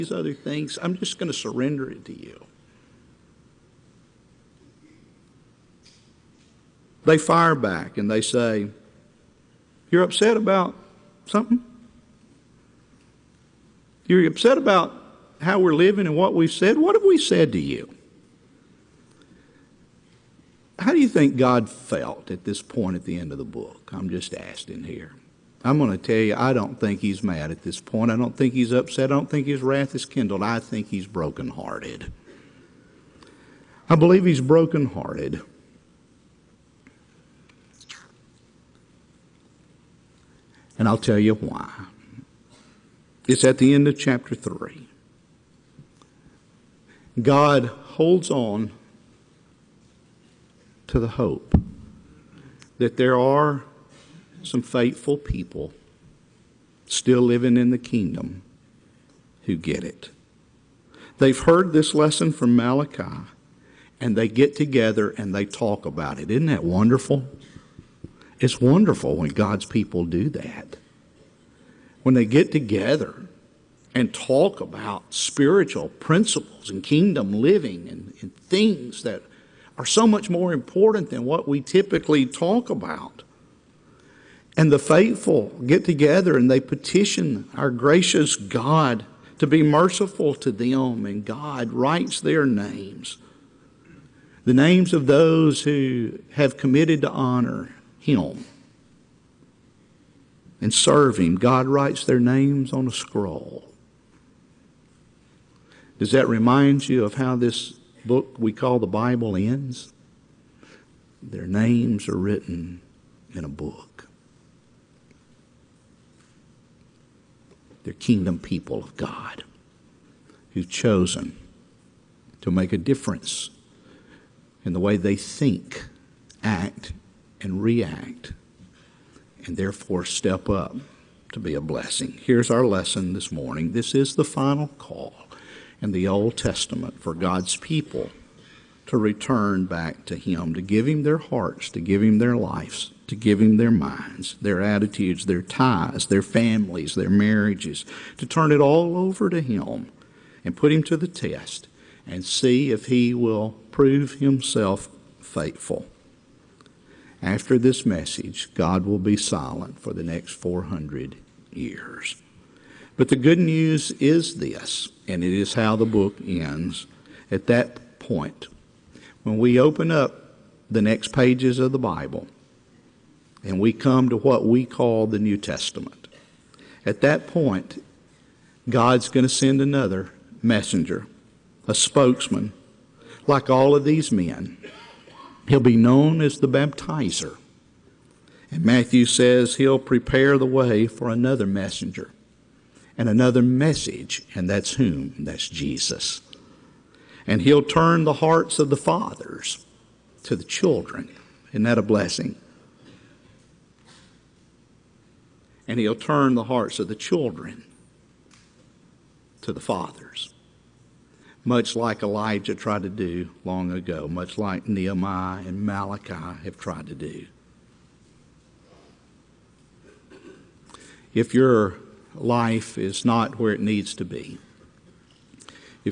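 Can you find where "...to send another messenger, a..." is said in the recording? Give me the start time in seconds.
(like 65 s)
179 s.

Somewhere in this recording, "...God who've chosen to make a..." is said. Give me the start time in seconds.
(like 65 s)
118 s.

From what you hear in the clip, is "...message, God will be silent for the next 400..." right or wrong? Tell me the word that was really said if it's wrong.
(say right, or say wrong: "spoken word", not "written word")
right.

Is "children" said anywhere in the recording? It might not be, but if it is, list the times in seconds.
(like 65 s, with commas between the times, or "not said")
200 s, 206 s.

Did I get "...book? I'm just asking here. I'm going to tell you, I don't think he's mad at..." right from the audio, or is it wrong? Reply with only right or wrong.
right.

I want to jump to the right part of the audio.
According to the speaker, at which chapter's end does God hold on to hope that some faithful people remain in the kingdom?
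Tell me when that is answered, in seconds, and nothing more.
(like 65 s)
43 s.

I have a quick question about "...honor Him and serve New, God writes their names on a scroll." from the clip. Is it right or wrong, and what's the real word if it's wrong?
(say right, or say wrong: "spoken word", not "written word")
wrong: "Him", not "New".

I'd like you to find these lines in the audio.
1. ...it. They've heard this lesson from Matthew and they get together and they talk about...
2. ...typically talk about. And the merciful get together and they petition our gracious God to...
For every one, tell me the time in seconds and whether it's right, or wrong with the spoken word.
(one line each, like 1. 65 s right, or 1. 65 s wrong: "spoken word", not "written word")
1. 59 s wrong: "Malachi", not "Matthew"
2. 81 s wrong: "faithful", not "merciful".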